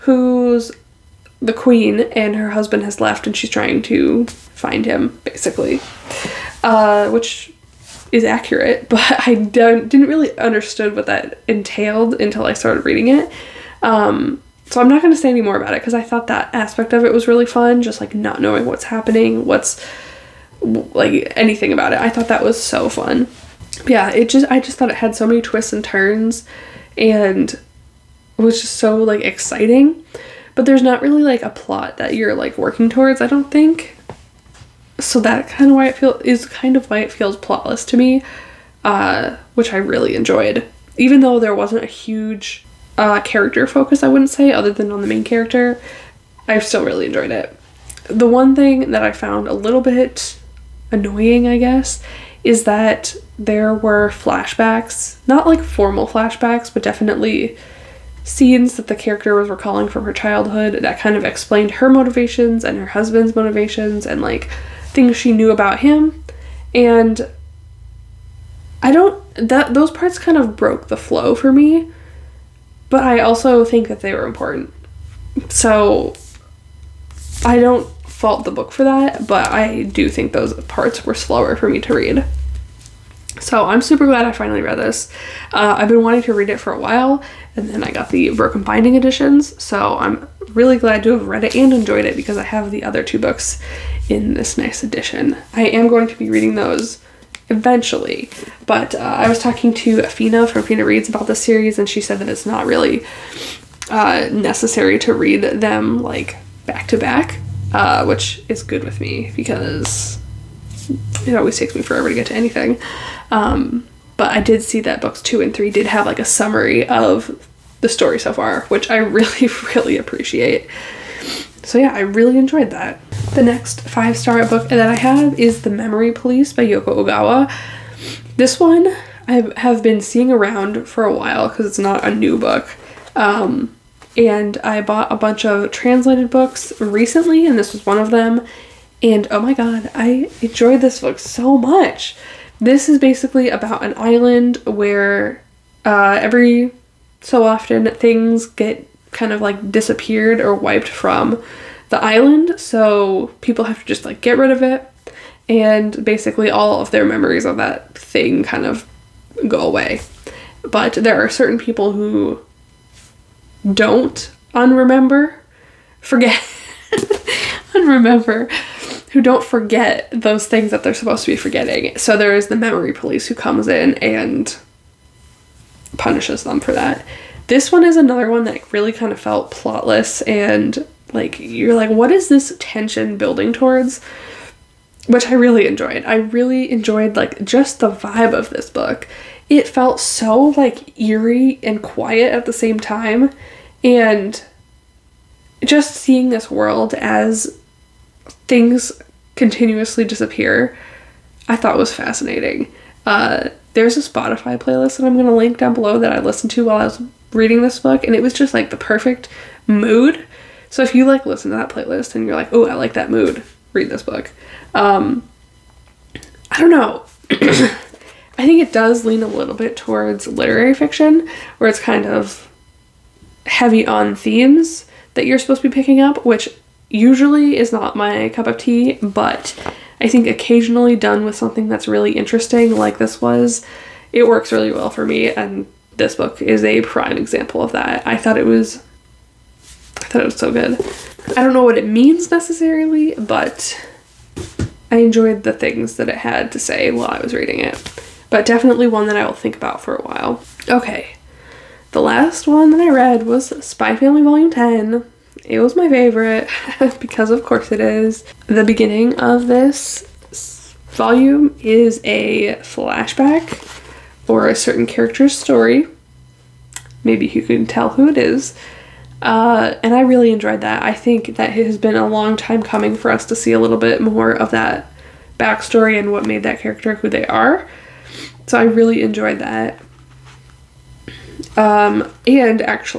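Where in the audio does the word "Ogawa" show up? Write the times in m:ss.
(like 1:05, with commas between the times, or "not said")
2:07.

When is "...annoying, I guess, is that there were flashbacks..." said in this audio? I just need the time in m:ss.
0:50.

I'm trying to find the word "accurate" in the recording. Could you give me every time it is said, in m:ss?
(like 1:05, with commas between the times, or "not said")
0:08.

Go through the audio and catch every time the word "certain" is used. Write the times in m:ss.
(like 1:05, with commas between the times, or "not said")
2:41, 4:24.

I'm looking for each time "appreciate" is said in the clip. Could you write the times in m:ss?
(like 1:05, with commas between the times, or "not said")
1:59.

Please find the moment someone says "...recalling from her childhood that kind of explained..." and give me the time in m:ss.
0:59.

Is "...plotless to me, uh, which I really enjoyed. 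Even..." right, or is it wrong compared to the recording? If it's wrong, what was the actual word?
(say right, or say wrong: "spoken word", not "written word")
right.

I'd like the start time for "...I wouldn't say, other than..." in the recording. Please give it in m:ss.
0:44.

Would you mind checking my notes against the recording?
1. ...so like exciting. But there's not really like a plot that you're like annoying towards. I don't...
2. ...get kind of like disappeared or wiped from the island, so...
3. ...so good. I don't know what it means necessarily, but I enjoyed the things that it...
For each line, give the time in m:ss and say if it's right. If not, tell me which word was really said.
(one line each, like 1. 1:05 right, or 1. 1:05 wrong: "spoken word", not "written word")
1. 0:28 wrong: "working", not "annoying"
2. 2:28 right
3. 4:00 right.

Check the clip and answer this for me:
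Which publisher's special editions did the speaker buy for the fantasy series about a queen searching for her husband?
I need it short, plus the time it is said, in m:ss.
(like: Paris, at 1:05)
Broken Binding, at 1:28.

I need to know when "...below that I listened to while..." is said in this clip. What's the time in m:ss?
3:25.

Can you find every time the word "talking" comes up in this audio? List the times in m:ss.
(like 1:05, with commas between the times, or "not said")
1:39.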